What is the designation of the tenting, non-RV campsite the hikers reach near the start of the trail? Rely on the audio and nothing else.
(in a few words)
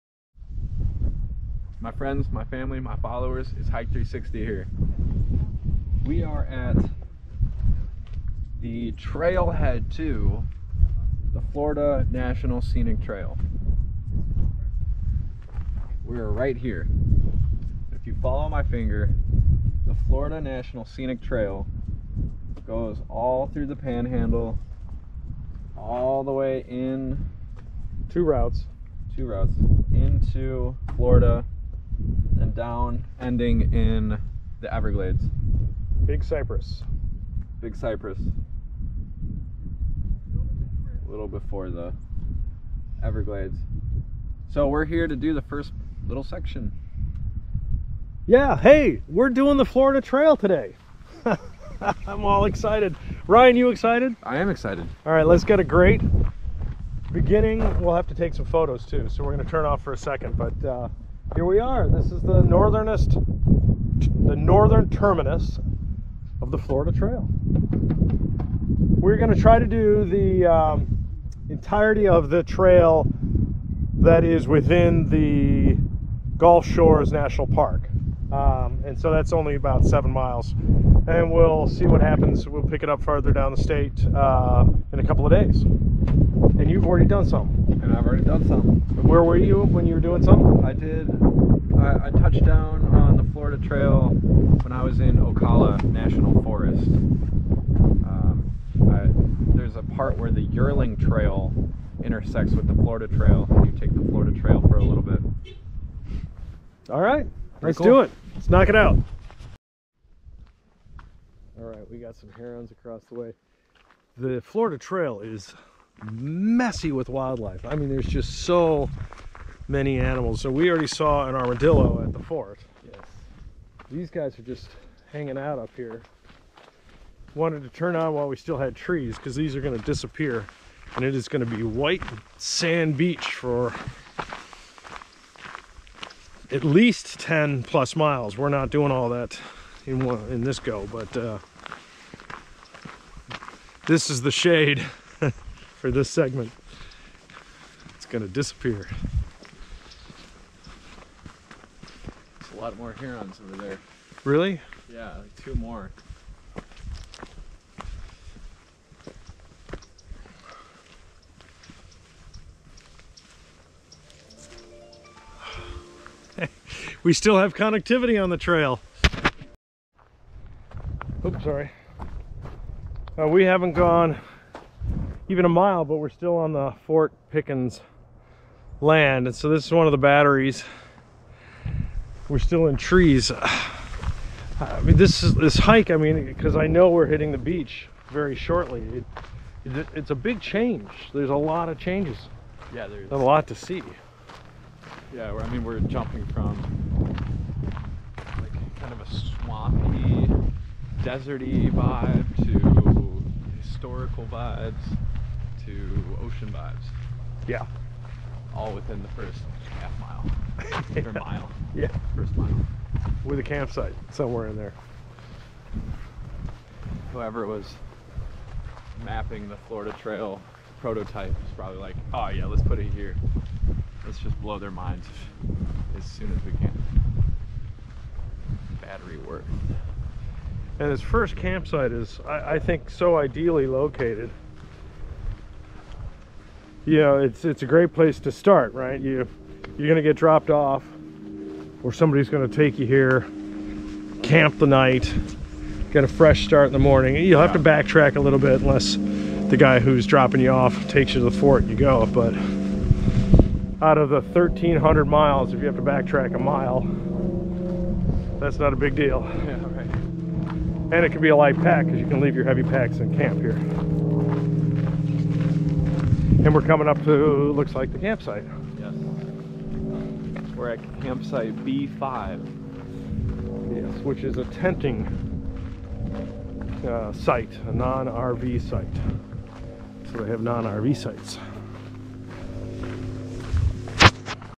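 B5.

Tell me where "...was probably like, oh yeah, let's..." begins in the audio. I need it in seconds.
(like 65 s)
221 s.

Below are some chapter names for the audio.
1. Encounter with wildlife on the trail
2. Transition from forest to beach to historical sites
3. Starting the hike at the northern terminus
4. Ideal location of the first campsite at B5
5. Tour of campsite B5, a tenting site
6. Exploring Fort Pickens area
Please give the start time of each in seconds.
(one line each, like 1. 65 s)
1. 91 s
2. 192 s
3. 51 s
4. 227 s
5. 270 s
6. 147 s.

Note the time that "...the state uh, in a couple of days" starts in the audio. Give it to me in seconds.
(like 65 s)
83 s.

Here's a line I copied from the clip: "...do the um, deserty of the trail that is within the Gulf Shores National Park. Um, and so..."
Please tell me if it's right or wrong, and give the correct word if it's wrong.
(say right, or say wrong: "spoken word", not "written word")
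wrong: "entirety", not "deserty".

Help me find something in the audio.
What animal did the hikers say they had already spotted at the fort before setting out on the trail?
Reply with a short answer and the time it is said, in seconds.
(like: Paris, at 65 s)
armadillo, at 121 s.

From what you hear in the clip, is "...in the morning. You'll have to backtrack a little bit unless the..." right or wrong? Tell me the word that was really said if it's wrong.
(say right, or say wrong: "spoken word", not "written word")
right.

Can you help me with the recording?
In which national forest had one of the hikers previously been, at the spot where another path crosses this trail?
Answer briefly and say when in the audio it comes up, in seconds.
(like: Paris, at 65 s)
Ocala National Forest, at 95 s.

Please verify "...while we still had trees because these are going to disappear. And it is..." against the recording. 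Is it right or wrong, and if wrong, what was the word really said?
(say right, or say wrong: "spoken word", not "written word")
right.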